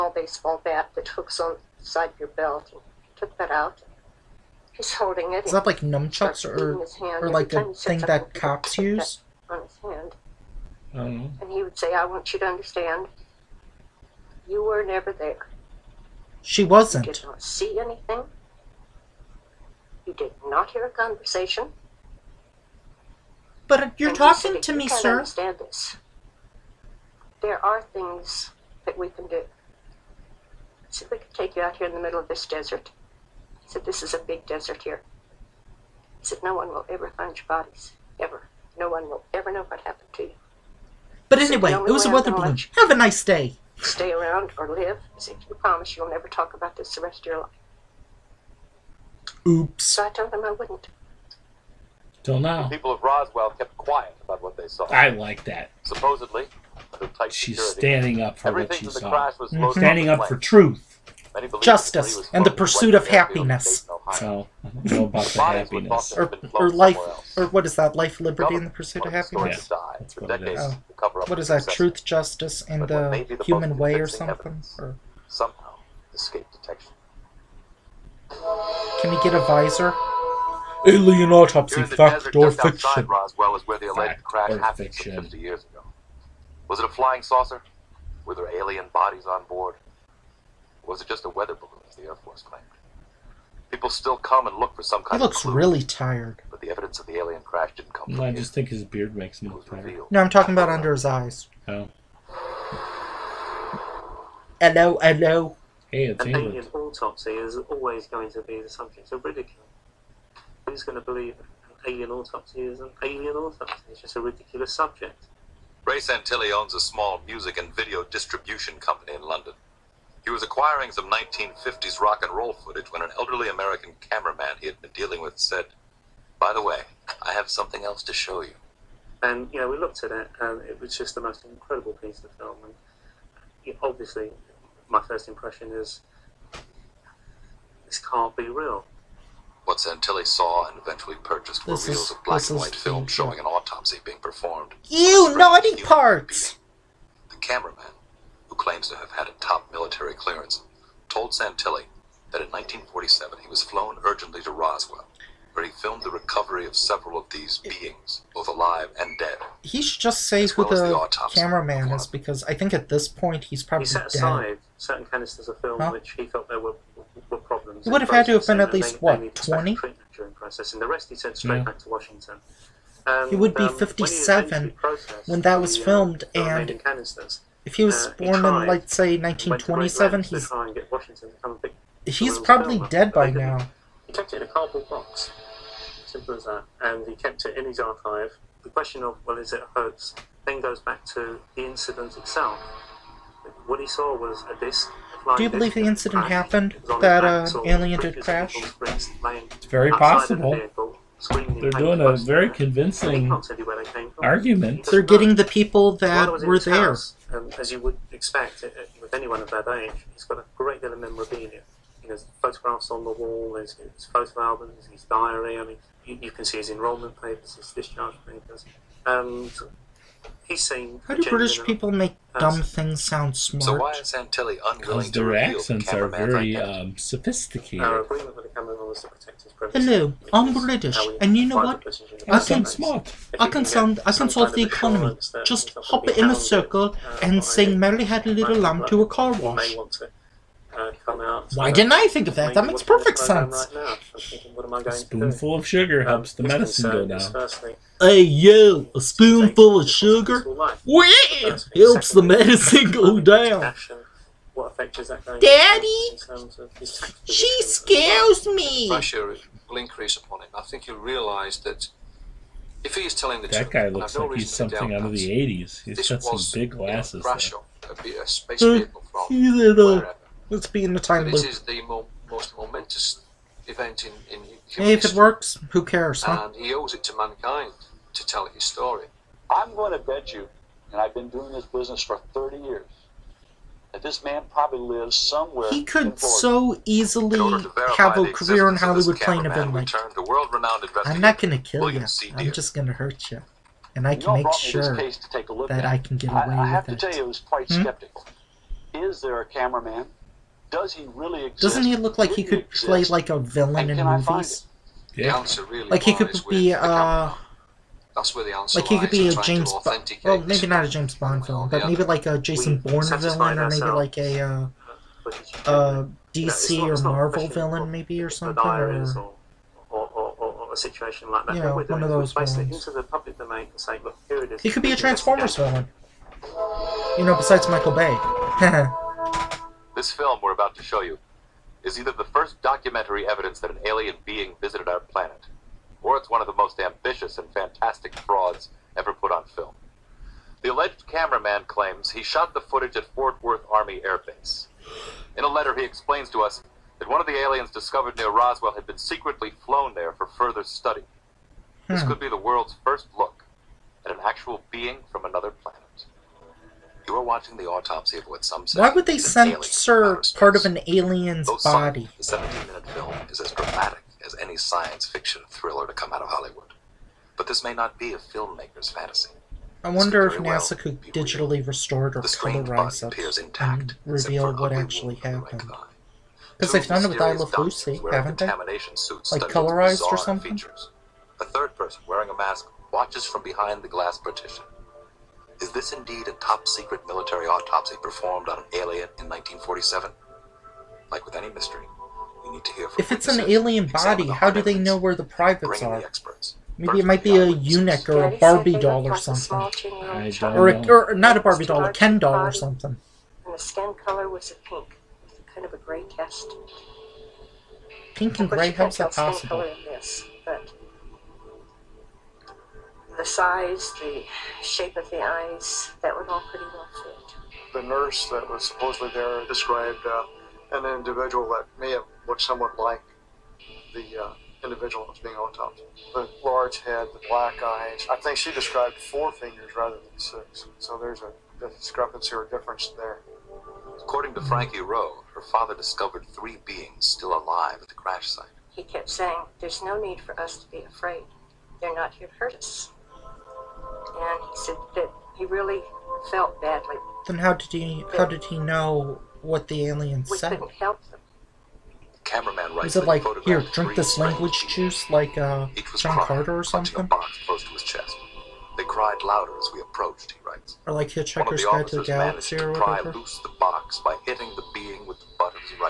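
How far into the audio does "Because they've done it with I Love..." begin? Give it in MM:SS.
06:16.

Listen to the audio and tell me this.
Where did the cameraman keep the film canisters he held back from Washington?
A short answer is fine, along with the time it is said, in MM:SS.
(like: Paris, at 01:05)
cardboard box, at 03:04.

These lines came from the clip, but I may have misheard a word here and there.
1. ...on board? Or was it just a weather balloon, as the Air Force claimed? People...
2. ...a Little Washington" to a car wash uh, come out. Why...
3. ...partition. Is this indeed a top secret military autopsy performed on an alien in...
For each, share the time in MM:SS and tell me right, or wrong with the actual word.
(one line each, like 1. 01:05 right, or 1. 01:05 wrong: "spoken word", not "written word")
1. 01:29 right
2. 03:58 wrong: "Lamb", not "Washington"
3. 06:24 right.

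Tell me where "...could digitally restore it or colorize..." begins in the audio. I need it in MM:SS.
06:10.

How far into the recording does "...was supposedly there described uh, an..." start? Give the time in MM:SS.
06:58.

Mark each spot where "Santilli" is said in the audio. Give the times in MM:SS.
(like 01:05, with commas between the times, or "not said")
01:55, 02:19, 02:31, 03:44.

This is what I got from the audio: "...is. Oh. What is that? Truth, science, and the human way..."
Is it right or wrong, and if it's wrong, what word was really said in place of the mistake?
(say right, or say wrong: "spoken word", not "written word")
wrong: "justice", not "science".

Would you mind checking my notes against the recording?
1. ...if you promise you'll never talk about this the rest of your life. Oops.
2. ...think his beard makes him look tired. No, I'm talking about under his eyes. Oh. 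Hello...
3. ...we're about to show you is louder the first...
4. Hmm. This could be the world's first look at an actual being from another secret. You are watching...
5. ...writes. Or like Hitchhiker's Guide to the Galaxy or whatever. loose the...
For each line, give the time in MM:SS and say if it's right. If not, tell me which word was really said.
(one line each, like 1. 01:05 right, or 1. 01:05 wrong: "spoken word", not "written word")
1. 00:45 right
2. 01:38 right
3. 05:30 wrong: "either", not "louder"
4. 05:51 wrong: "planet", not "secret"
5. 07:40 right.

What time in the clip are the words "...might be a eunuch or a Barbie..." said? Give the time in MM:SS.
06:37.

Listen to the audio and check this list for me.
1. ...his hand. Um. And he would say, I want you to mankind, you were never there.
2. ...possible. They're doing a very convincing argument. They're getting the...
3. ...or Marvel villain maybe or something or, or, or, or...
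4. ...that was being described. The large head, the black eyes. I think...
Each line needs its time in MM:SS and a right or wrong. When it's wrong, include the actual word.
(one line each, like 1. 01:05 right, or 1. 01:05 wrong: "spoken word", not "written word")
1. 00:09 wrong: "understand", not "mankind"
2. 03:19 right
3. 05:16 right
4. 07:05 wrong: "autopsied", not "described".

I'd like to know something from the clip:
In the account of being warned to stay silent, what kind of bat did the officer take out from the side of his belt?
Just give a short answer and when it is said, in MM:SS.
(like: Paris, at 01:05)
baseball bat, at 00:00.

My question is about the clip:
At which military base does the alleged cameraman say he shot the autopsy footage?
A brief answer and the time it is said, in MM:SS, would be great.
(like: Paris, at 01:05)
Fort Worth Army Air Base, at 05:43.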